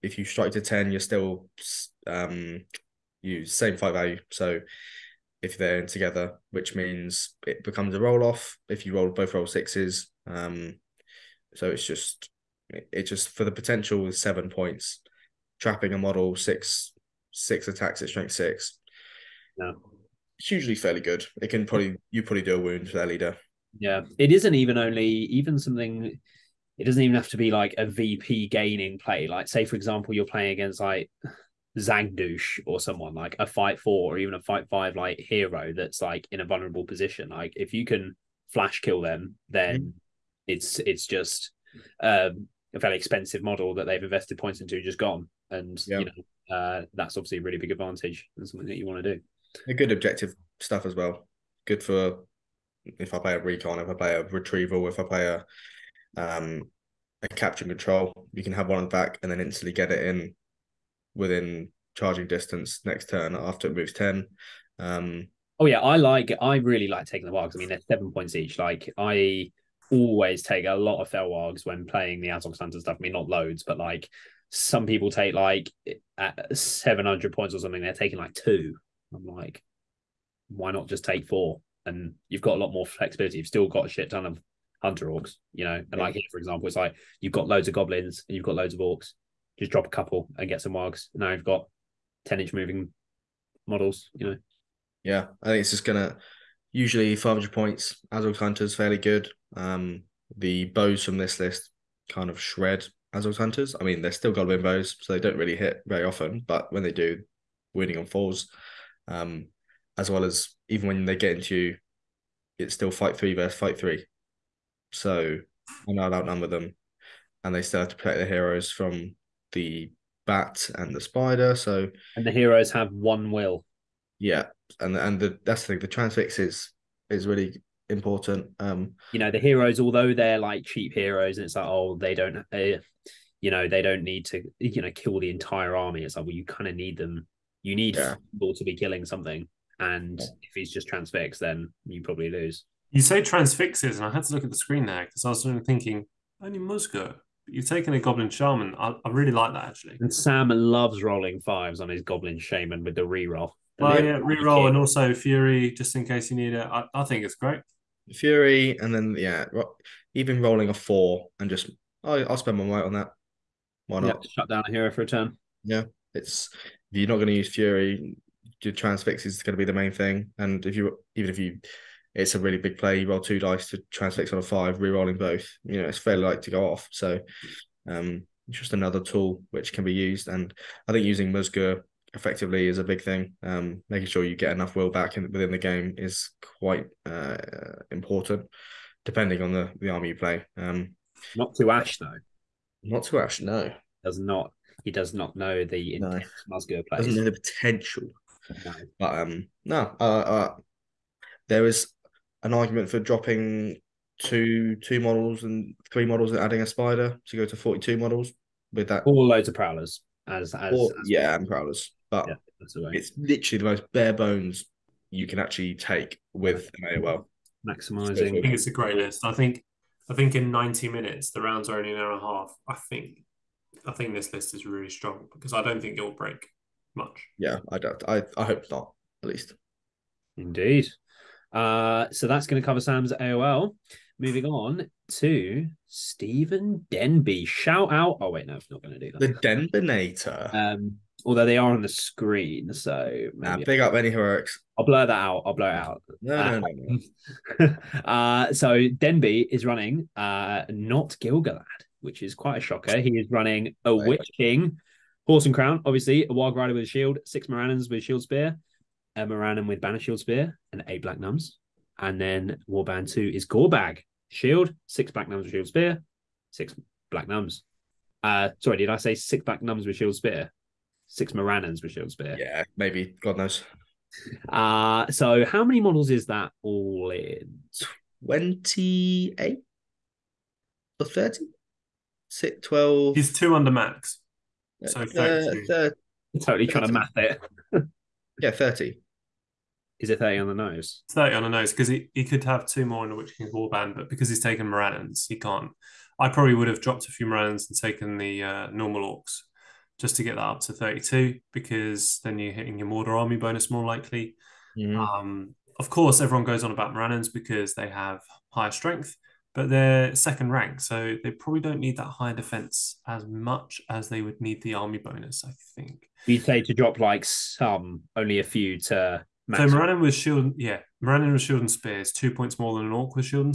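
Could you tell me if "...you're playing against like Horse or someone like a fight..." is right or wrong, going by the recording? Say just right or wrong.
wrong.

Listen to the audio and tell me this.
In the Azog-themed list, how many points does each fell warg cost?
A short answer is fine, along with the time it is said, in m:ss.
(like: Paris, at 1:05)
7, at 1:07.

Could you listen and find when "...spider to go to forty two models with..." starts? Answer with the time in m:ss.
3:26.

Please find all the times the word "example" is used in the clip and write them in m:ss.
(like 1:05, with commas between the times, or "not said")
0:29, 1:26.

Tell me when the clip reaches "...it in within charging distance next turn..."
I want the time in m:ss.
0:59.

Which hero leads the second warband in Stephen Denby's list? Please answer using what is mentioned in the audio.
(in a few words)
Gorbag.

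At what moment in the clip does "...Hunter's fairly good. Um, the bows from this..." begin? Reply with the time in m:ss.
1:38.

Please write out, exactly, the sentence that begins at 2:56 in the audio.
So, um, just another tool which can be used.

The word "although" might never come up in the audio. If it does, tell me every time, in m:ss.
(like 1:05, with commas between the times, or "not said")
2:09, 4:01.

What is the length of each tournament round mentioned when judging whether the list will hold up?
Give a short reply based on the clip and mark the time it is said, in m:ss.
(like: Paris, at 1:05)
90 minutes, at 3:40.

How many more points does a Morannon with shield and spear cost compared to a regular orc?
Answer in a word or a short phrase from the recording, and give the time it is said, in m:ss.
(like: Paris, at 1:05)
2, at 5:22.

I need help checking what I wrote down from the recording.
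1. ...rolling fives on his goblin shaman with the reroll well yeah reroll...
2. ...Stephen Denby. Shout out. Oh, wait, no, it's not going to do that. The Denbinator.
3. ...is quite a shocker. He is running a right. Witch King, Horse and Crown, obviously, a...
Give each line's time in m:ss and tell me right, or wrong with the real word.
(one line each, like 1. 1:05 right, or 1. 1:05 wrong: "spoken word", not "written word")
1. 2:31 right
2. 3:55 right
3. 4:12 right.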